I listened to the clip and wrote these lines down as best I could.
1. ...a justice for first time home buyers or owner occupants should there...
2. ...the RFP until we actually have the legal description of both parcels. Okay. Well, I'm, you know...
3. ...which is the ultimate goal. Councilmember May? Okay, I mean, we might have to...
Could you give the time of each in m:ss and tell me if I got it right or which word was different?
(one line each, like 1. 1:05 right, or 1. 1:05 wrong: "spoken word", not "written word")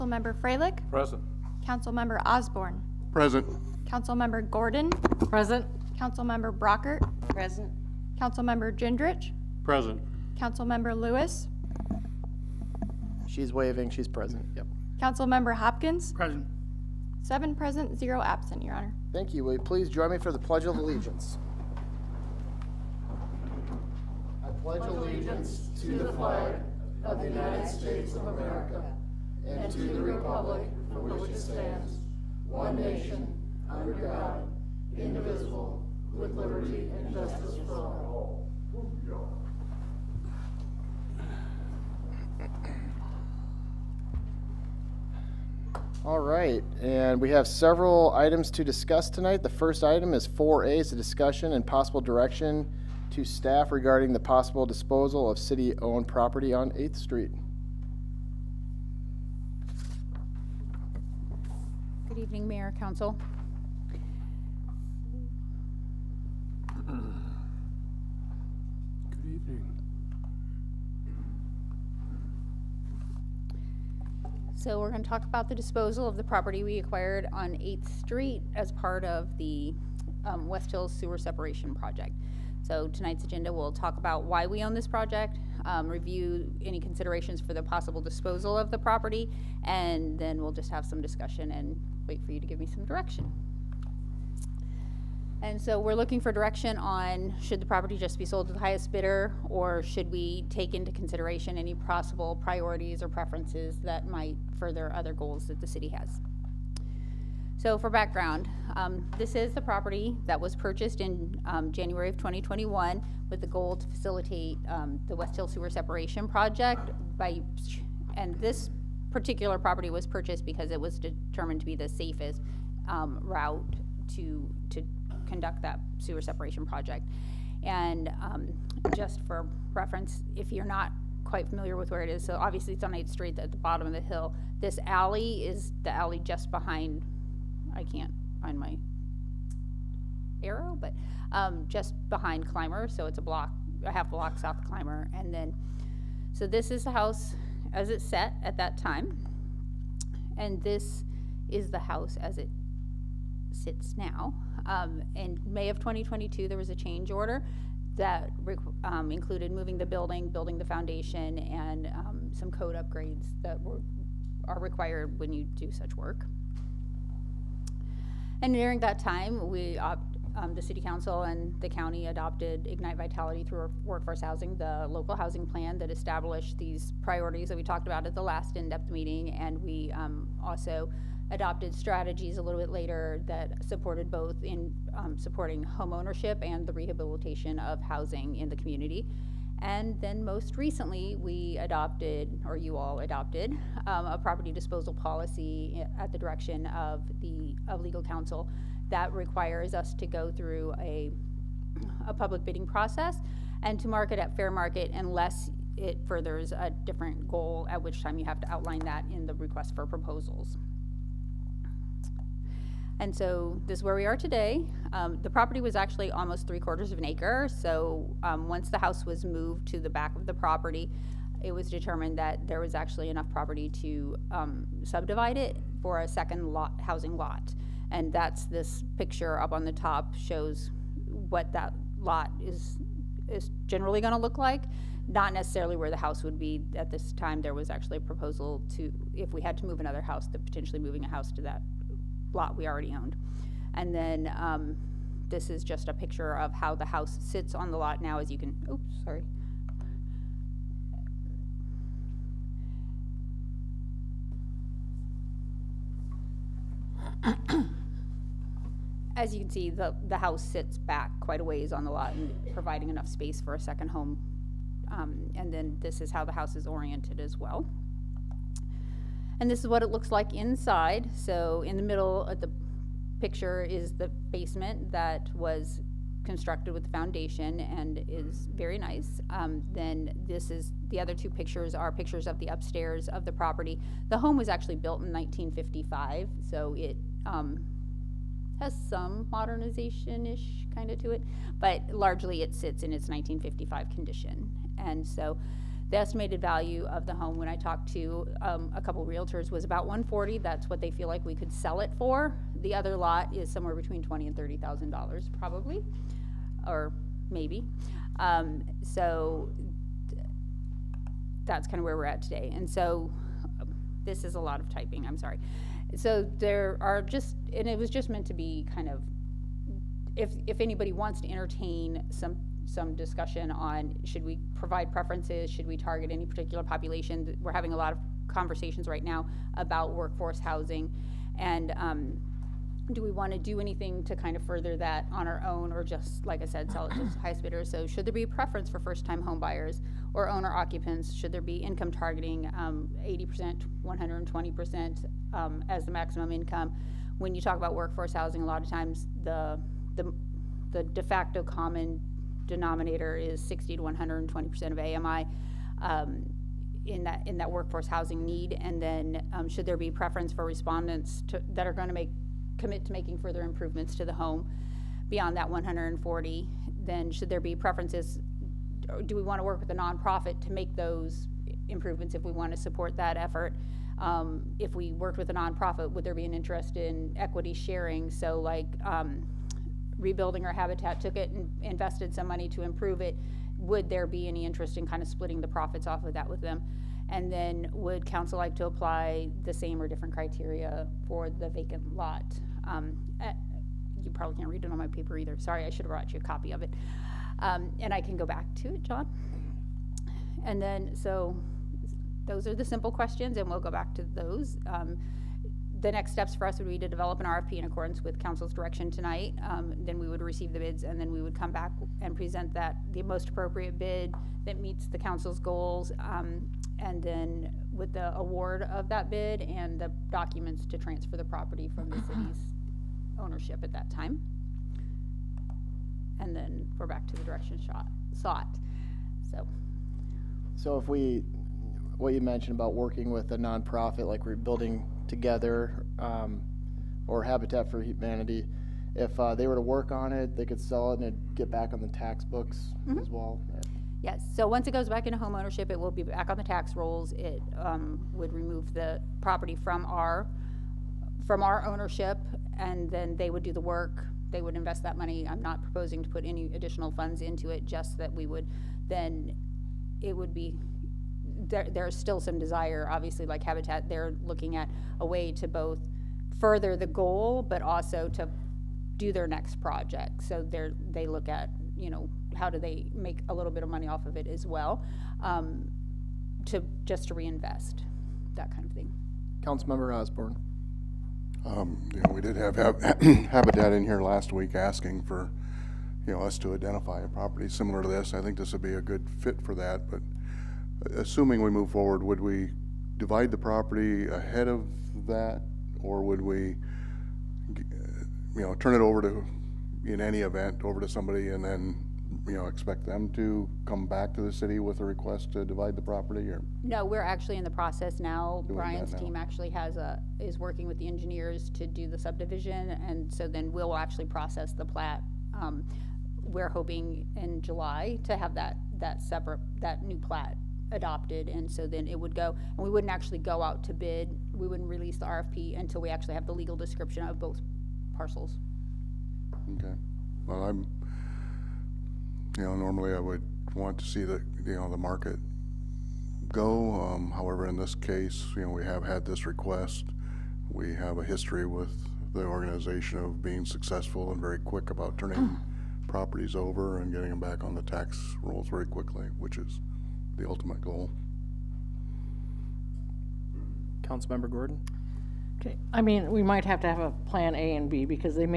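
1. 5:38 wrong: "preference", not "justice"
2. 8:44 right
3. 9:09 wrong: "Gordon", not "May".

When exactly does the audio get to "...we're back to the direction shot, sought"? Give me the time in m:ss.
7:06.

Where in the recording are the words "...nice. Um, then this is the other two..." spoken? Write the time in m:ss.
4:38.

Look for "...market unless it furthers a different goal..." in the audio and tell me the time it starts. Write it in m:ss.
3:24.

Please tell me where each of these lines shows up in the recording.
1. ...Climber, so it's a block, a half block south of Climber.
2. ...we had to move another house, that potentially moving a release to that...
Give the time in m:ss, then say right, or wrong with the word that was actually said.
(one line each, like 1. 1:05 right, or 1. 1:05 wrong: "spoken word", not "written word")
1. 2:22 right
2. 3:59 wrong: "house", not "release".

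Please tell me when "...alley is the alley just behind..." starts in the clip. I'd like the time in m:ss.
2:14.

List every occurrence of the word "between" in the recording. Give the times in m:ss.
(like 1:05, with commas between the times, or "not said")
5:03.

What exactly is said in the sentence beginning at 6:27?
And then would council like to apply the same or different criteria for the vacant lot?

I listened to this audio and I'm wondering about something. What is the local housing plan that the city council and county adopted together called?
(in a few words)
Ignite Vitality through workforce housing.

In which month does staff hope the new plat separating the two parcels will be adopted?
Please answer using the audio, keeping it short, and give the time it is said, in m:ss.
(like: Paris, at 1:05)
July, at 8:37.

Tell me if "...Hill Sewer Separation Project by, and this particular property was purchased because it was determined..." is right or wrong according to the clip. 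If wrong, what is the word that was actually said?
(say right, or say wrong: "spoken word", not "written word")
right.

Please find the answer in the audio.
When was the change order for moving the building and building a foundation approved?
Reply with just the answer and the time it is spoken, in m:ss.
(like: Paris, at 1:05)
May 2022, at 2:35.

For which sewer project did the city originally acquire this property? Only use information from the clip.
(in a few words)
West Hills Sewer Separation Project.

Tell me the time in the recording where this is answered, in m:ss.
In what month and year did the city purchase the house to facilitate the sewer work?
1:51.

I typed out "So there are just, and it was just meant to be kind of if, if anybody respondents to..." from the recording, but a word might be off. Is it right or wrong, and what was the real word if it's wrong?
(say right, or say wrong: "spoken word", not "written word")
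wrong: "wants", not "respondents".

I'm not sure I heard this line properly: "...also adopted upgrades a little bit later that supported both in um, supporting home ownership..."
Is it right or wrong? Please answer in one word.
wrong.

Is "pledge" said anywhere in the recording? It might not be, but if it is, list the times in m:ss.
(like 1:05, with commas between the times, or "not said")
0:20, 0:24.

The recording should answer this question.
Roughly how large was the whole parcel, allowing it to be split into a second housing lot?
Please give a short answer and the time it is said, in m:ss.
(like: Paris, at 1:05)
three quarters of an acre, at 3:36.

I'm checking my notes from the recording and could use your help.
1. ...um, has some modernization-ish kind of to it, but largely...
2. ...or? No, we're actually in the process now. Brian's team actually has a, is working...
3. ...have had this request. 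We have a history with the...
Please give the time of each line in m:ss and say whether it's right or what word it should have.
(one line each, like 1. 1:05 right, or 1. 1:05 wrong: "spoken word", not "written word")
1. 4:47 right
2. 8:26 right
3. 8:58 right.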